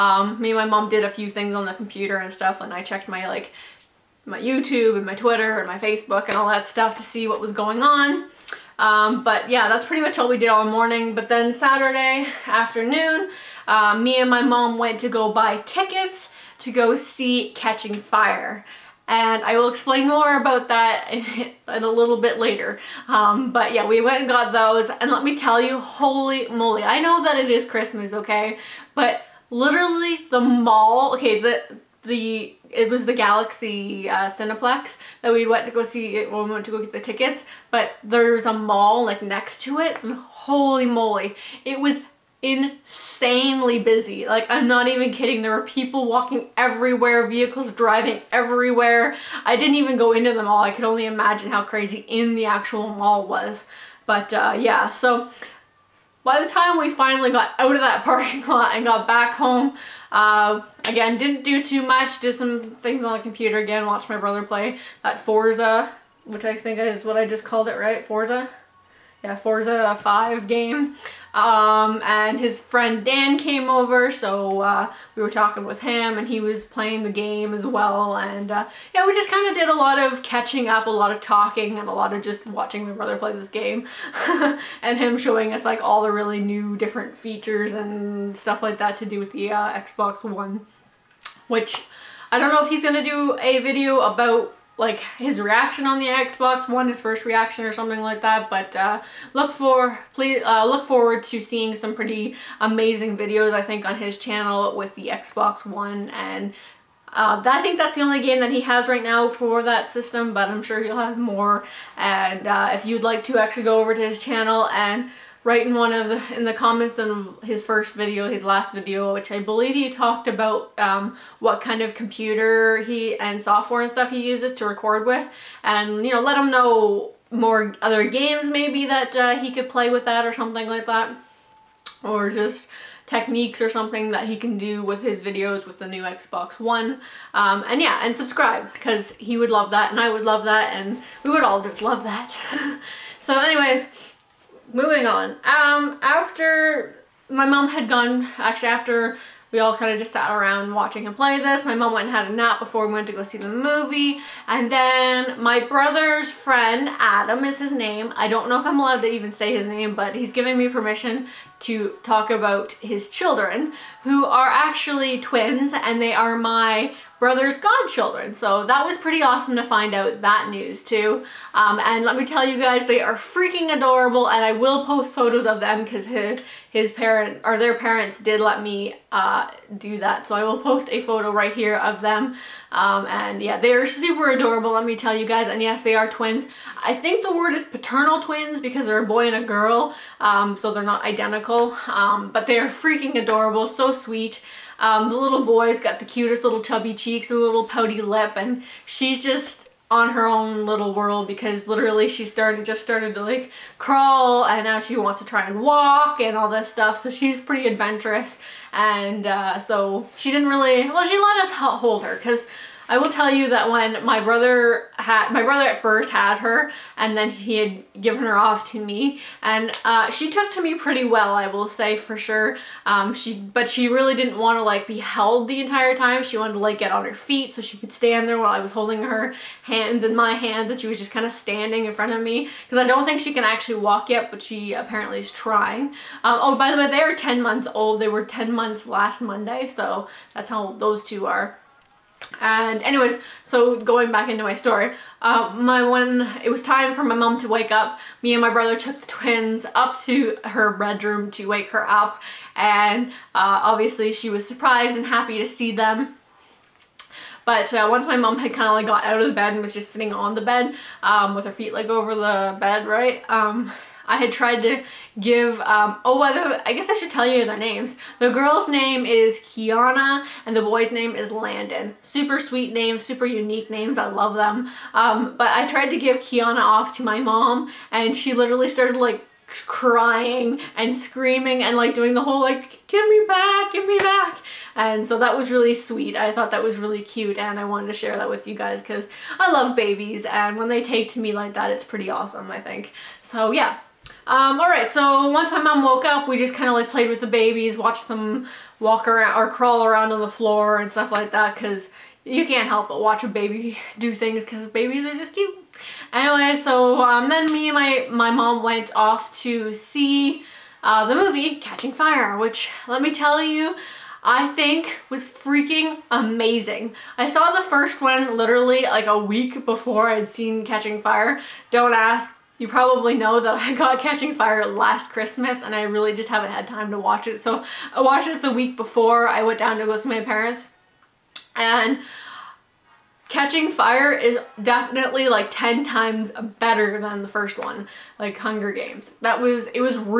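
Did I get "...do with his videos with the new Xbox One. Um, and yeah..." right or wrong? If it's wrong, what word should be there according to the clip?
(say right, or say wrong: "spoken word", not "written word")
right.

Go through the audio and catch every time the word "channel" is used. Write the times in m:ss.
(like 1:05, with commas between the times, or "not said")
1:44, 1:54.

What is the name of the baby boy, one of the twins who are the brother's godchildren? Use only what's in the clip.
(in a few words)
Landon.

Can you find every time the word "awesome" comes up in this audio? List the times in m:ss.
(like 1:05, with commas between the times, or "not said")
2:49, 4:52.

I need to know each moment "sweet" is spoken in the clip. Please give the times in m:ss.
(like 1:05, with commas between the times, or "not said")
3:13, 4:32, 4:45.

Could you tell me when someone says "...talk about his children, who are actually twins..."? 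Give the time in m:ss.
2:42.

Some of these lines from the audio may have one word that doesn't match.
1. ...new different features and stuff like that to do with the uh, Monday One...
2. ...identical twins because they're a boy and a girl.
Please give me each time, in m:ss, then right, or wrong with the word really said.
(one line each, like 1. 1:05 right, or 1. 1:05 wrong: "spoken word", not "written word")
1. 1:26 wrong: "Xbox", not "Monday"
2. 3:07 wrong: "paternal", not "identical".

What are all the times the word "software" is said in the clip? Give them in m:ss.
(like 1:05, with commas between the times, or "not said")
2:03.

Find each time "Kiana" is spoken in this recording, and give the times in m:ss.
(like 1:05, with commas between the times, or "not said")
4:29, 4:36.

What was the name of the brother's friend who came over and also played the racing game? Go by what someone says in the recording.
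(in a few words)
Dan.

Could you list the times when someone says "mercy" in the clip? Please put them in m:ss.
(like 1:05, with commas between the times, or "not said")
not said.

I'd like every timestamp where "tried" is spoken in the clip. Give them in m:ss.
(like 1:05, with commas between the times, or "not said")
4:24, 4:35.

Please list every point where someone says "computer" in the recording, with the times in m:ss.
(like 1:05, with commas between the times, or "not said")
0:01, 1:03, 2:01.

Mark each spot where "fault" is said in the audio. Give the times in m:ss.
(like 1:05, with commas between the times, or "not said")
not said.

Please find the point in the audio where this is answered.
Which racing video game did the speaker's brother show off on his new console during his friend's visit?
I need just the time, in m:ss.
1:09.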